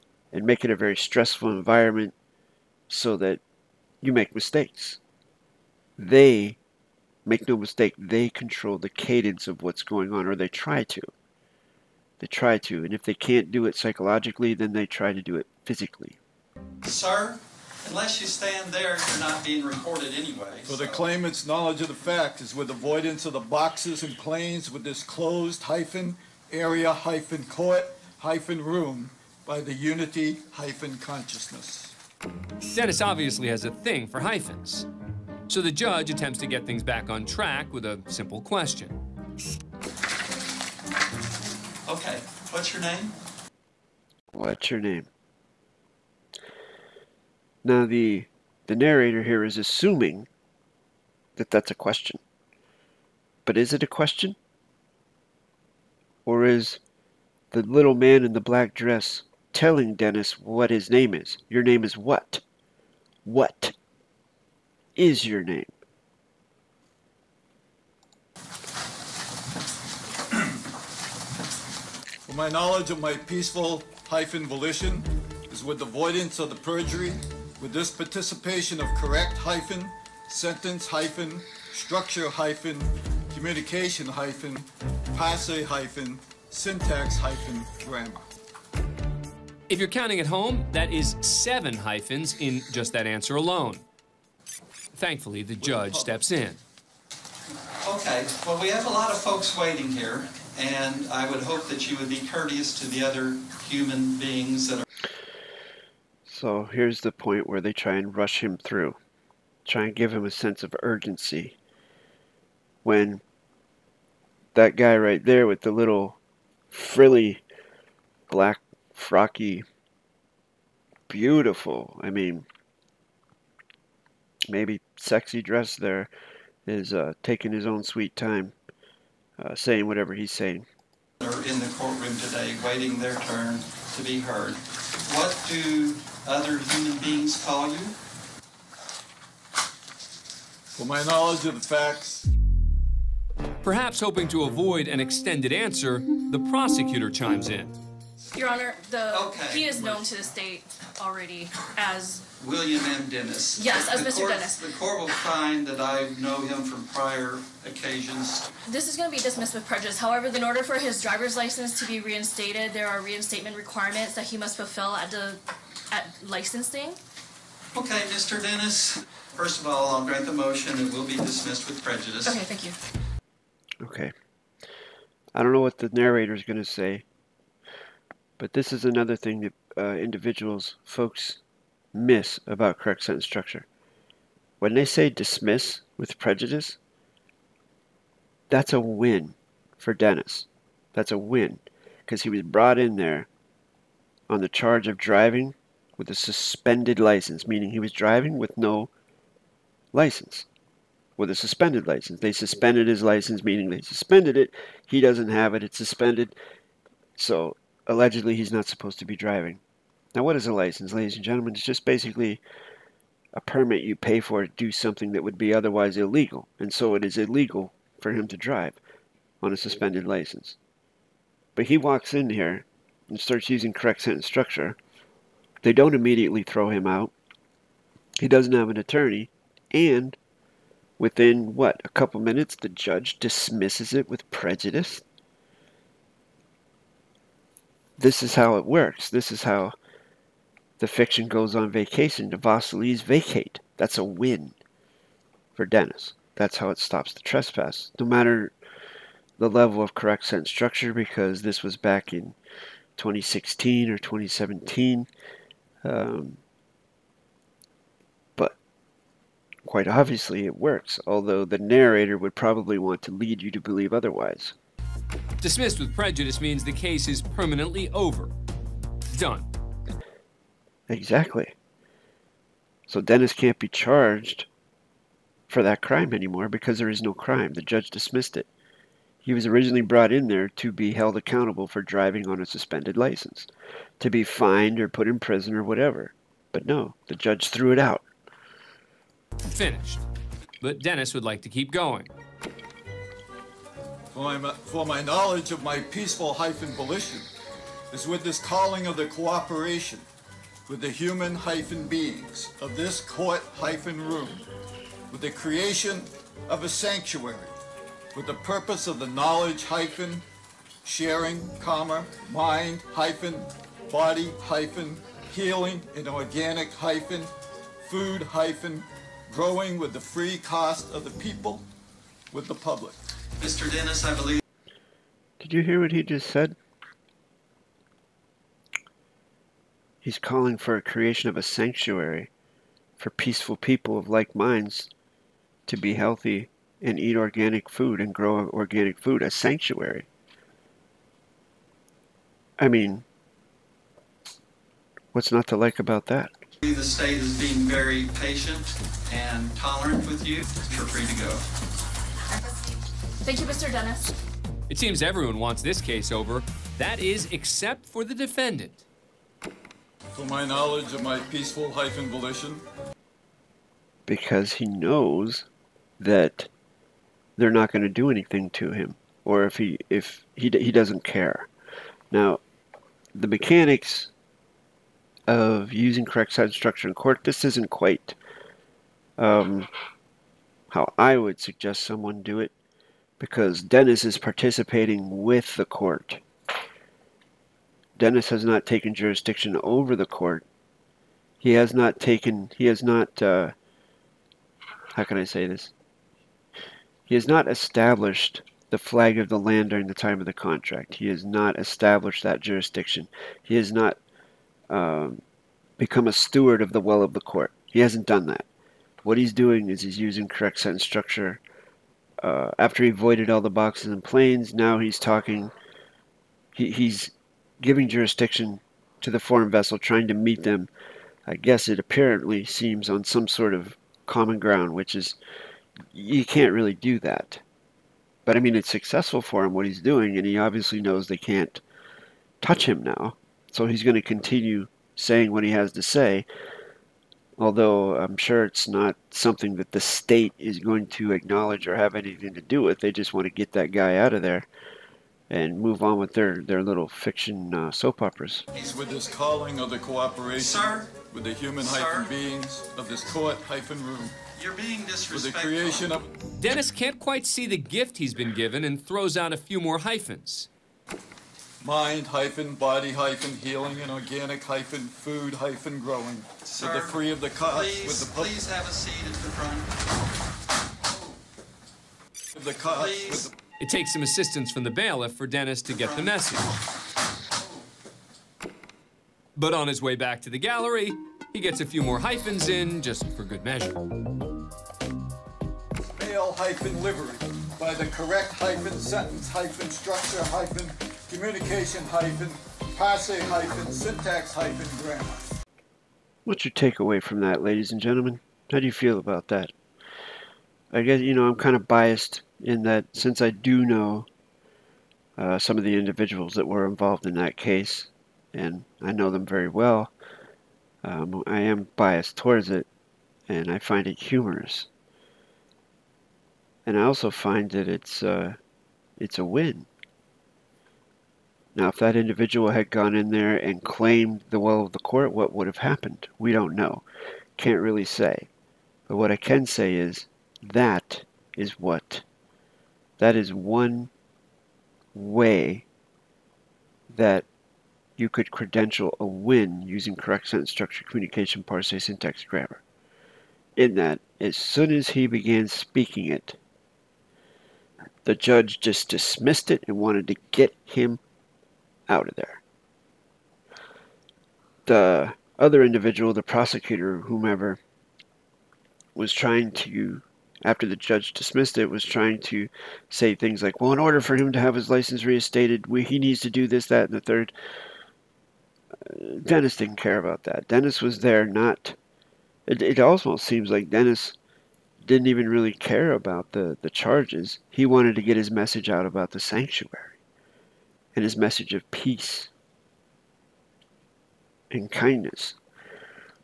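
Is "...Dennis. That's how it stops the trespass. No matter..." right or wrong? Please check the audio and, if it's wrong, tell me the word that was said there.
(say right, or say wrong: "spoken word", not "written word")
right.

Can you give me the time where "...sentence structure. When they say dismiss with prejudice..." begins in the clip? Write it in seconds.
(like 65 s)
183 s.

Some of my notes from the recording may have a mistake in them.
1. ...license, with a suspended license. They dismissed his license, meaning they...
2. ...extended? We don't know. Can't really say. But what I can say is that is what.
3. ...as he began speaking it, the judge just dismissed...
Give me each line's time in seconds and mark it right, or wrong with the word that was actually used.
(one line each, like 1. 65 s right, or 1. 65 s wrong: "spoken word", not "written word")
1. 199 s wrong: "suspended", not "dismissed"
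2. 525 s wrong: "happened", not "extended"
3. 544 s right.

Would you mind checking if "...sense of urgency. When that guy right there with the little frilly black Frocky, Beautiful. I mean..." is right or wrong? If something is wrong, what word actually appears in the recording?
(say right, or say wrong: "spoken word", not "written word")
right.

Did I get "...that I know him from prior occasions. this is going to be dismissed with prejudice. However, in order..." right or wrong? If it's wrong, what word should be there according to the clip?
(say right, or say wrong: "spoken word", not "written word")
right.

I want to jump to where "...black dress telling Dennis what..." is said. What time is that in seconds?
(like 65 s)
58 s.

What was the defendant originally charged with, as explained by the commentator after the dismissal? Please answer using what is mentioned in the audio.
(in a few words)
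Driving with a suspended license.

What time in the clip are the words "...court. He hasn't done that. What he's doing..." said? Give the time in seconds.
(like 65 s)
407 s.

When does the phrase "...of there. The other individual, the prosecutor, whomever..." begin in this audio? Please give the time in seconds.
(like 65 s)
552 s.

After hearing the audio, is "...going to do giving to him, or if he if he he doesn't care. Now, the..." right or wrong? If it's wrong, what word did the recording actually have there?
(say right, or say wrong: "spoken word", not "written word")
wrong: "anything", not "giving".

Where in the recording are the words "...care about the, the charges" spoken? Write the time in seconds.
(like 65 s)
575 s.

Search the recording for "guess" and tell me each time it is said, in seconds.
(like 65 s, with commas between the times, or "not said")
421 s, 500 s.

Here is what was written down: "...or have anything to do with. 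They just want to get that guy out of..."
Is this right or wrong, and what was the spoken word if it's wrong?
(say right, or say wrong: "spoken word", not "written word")
right.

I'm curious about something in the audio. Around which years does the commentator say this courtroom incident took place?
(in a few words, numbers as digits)
2016 or 2017.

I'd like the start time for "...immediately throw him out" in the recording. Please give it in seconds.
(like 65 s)
225 s.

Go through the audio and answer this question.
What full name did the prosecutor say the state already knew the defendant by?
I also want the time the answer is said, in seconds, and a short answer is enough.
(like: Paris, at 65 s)
William M. Dennis, at 152 s.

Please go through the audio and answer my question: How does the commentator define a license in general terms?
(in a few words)
A permit you pay for.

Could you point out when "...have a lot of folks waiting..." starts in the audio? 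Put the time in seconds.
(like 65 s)
98 s.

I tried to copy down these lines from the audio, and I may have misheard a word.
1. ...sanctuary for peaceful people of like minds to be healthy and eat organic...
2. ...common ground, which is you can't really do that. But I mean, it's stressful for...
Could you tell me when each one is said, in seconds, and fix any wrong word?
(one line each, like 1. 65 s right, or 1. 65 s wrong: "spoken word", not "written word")
1. 331 s right
2. 424 s wrong: "successful", not "stressful".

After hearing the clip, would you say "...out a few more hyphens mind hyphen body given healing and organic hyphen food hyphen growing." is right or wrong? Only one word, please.
wrong.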